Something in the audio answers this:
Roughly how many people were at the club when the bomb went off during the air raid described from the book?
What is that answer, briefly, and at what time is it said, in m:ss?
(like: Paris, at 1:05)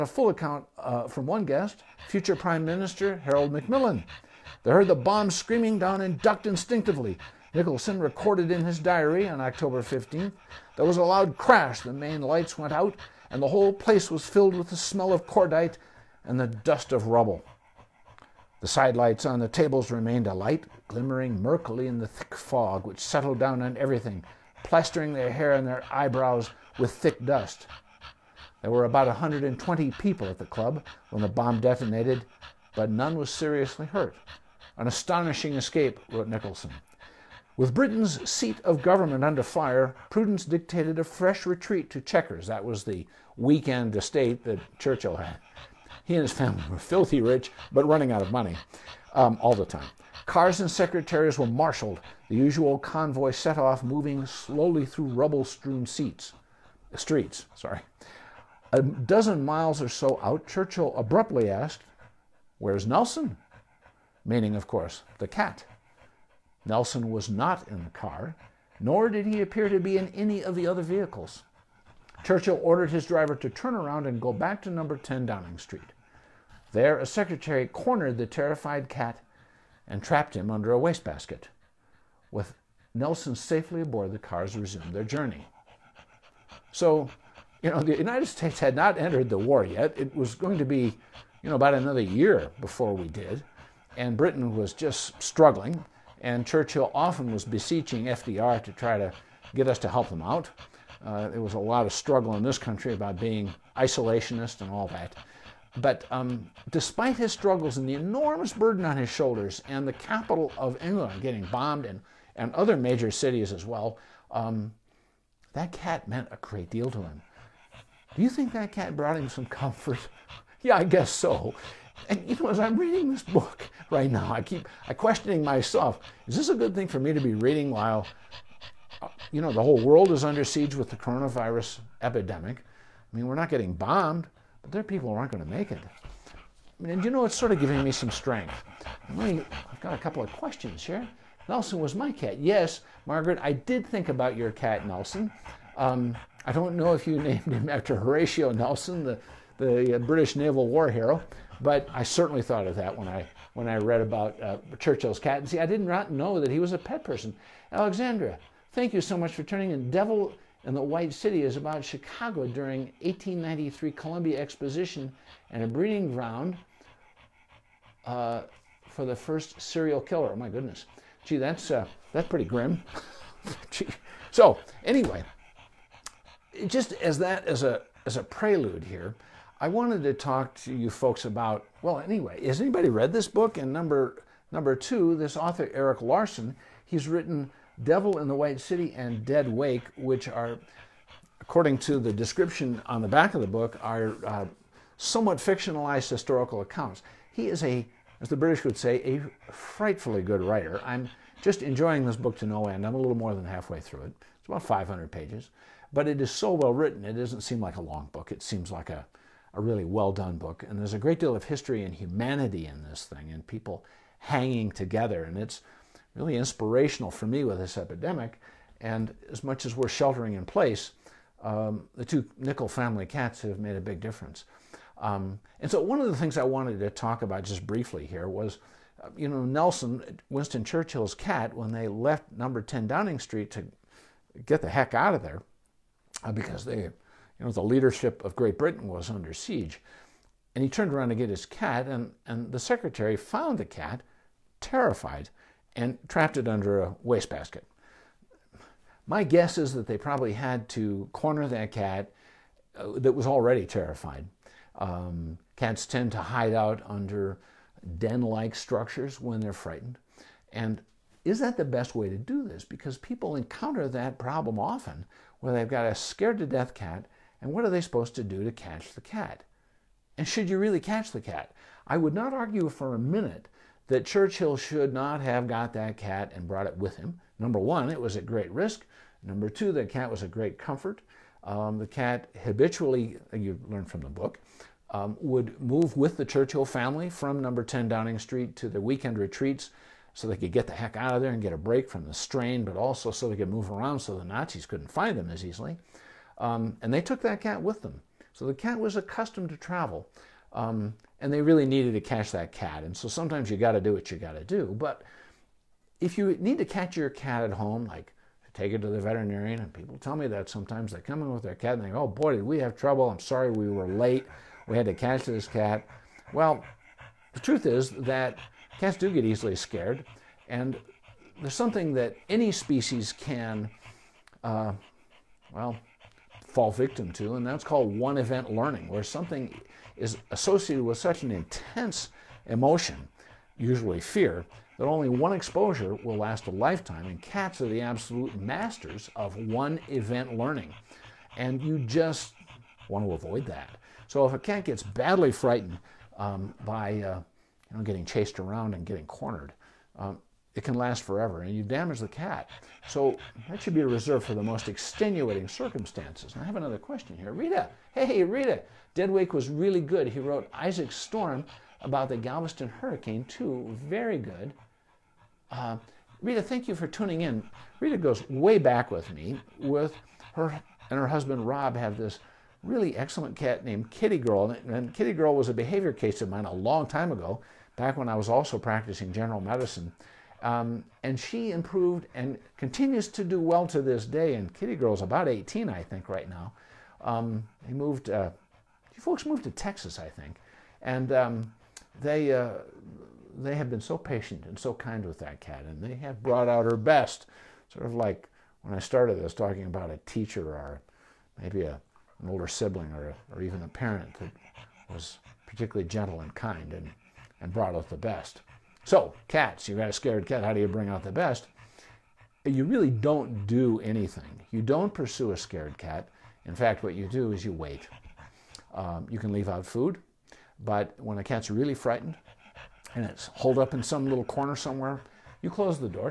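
120, at 0:28.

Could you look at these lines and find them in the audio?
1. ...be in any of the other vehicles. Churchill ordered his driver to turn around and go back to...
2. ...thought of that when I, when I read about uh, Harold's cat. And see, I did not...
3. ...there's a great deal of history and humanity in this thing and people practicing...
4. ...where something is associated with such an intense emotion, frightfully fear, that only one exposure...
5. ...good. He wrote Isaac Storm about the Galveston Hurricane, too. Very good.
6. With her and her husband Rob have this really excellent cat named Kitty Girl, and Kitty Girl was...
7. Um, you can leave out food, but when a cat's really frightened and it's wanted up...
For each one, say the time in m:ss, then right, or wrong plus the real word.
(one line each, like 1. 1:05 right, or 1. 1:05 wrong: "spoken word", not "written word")
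1. 1:09 right
2. 2:32 wrong: "Churchill", not "Harold"
3. 3:30 wrong: "hanging", not "practicing"
4. 5:28 wrong: "usually", not "frightfully"
5. 5:59 right
6. 6:09 right
7. 6:58 wrong: "holed", not "wanted".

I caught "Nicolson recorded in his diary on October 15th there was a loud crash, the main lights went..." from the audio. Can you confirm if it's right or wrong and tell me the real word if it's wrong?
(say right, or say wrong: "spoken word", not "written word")
right.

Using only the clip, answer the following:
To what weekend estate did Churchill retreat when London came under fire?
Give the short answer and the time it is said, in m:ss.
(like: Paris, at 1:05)
Chequers, at 0:42.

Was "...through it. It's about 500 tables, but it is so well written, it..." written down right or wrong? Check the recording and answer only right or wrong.
wrong.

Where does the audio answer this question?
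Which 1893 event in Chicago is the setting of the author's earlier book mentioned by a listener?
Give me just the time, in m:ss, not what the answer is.
2:43.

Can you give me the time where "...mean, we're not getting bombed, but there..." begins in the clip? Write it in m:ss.
2:13.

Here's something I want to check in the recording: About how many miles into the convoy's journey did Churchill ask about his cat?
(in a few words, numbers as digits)
A dozen.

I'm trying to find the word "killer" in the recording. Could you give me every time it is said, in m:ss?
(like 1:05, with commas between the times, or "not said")
2:50.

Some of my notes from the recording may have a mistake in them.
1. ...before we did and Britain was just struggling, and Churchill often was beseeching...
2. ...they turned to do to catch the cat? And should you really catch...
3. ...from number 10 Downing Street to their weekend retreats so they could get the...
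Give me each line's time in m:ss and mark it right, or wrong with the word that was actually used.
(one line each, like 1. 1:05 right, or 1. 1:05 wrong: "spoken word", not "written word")
1. 1:32 right
2. 4:27 wrong: "supposed", not "turned"
3. 4:47 right.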